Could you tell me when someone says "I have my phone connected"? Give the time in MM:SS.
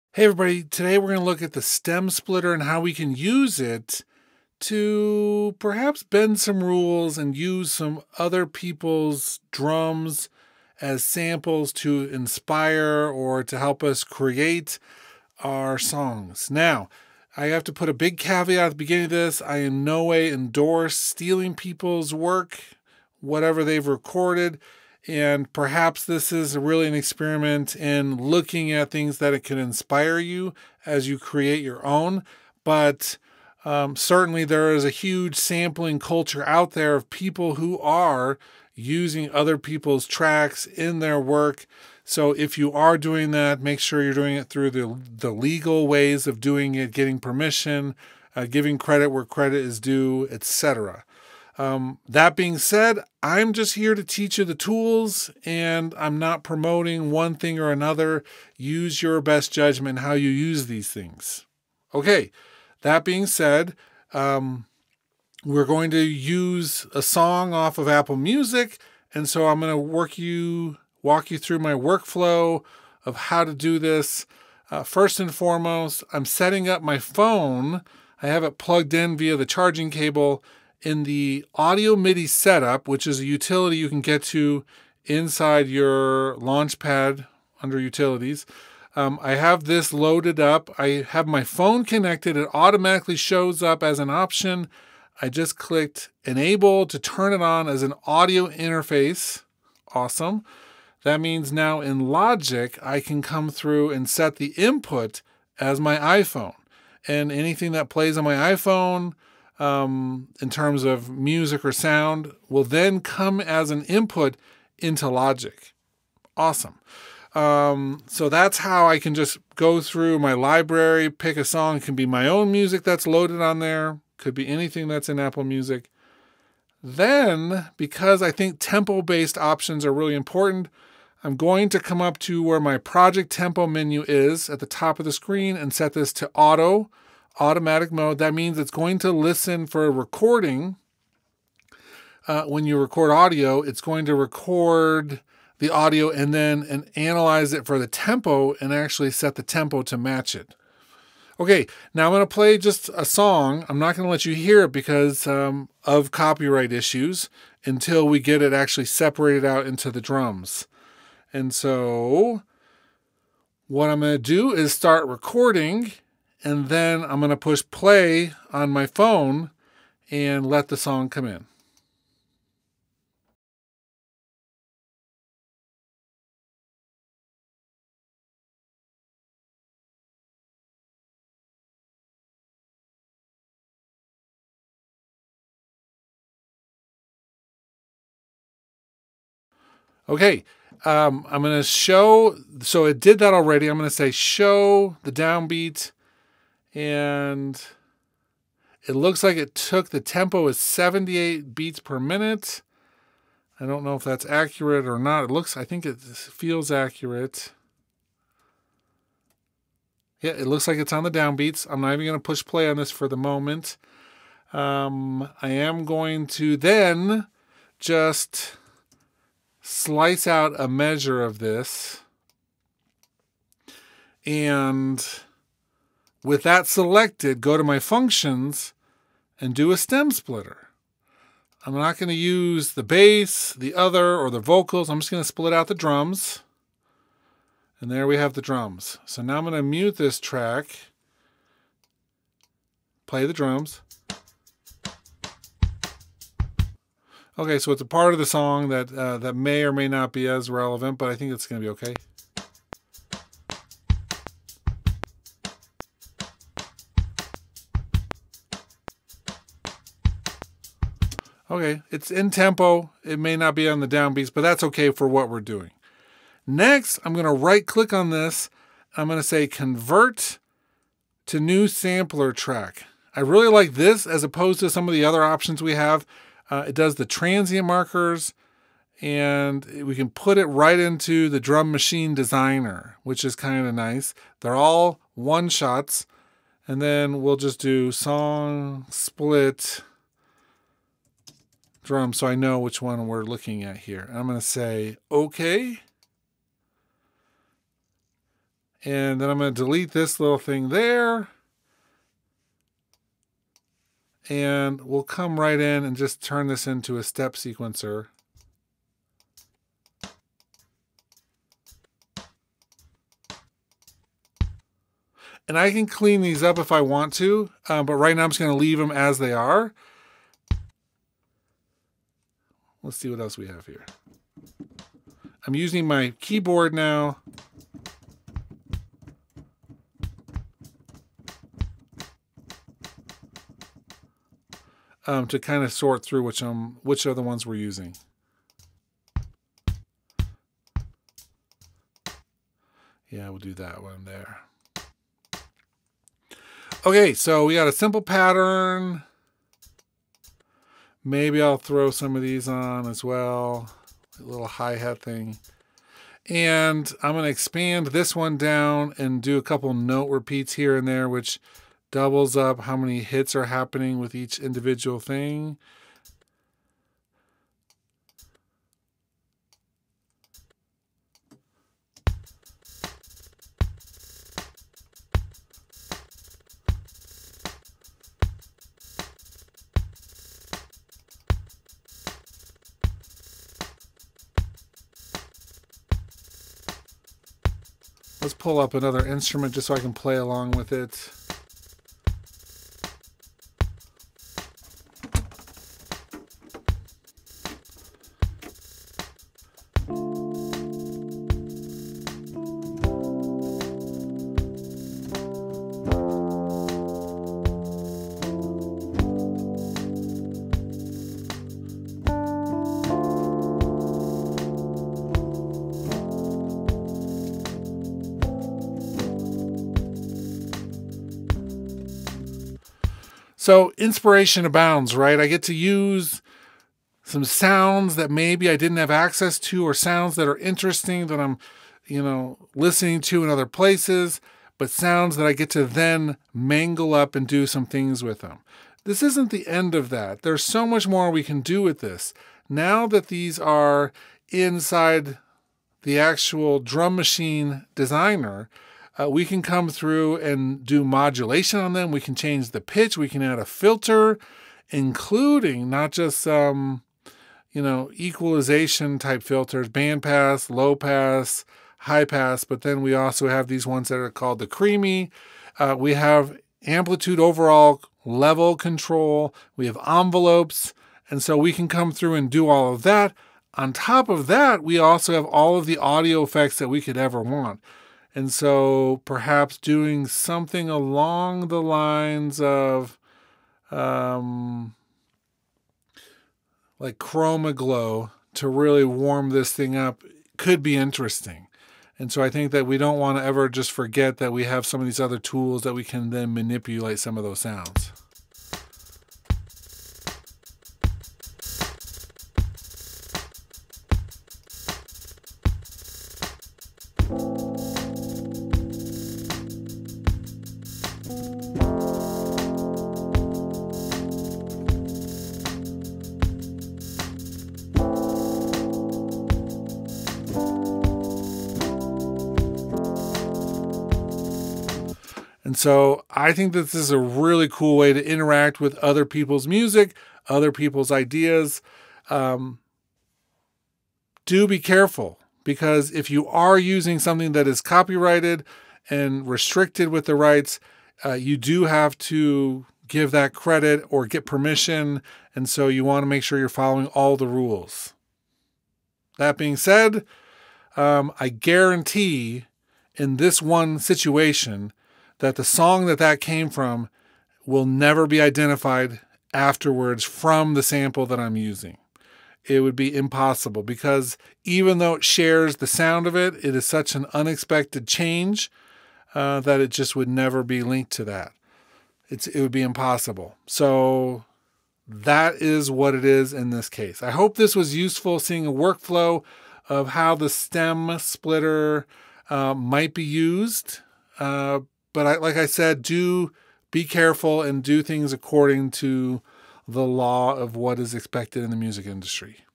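01:30.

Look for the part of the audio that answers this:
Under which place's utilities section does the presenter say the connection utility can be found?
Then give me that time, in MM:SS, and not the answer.
01:26.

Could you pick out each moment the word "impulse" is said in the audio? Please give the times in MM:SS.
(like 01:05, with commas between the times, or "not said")
not said.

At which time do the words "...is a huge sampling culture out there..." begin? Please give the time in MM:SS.
00:34.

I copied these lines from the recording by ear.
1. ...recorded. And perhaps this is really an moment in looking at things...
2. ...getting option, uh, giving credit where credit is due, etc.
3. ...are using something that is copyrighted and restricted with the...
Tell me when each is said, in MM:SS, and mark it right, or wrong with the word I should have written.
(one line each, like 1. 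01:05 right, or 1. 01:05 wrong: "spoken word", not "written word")
1. 00:23 wrong: "experiment", not "moment"
2. 00:46 wrong: "permission", not "option"
3. 08:56 right.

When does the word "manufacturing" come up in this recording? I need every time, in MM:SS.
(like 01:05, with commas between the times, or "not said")
not said.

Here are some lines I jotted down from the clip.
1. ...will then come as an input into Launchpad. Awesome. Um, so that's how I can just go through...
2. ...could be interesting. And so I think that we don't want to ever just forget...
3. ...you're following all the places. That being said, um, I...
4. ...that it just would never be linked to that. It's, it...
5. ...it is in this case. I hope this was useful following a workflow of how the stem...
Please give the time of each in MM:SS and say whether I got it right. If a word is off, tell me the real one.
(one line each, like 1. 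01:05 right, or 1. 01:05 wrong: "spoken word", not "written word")
1. 01:52 wrong: "Logic", not "Launchpad"
2. 08:10 right
3. 09:06 wrong: "rules", not "places"
4. 09:29 right
5. 09:35 wrong: "seeing", not "following".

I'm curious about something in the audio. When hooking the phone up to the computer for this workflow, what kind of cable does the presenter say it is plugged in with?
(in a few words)
charging cable.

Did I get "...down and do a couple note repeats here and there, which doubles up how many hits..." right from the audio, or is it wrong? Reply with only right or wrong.
right.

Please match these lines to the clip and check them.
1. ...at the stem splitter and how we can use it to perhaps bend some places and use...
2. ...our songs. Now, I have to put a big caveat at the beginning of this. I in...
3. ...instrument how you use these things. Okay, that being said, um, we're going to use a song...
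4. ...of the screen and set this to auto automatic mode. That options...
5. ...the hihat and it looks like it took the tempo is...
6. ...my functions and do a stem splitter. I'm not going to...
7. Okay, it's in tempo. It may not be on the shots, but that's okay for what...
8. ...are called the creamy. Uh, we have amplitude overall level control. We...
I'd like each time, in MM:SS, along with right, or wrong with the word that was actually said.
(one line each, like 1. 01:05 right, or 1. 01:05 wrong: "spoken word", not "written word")
1. 00:01 wrong: "rules", not "places"
2. 00:15 right
3. 00:59 wrong: "judgment", not "instrument"
4. 02:14 wrong: "means", not "options"
5. 03:15 wrong: "downbeat", not "hihat"
6. 03:47 right
7. 04:21 wrong: "downbeats", not "shots"
8. 07:43 right.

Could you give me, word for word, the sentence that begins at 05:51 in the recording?
Maybe I'll throw some of these on as well.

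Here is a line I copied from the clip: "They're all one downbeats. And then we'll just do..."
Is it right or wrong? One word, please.
wrong.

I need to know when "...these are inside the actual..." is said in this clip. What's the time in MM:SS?
07:23.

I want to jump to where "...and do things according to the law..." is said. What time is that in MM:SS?
09:47.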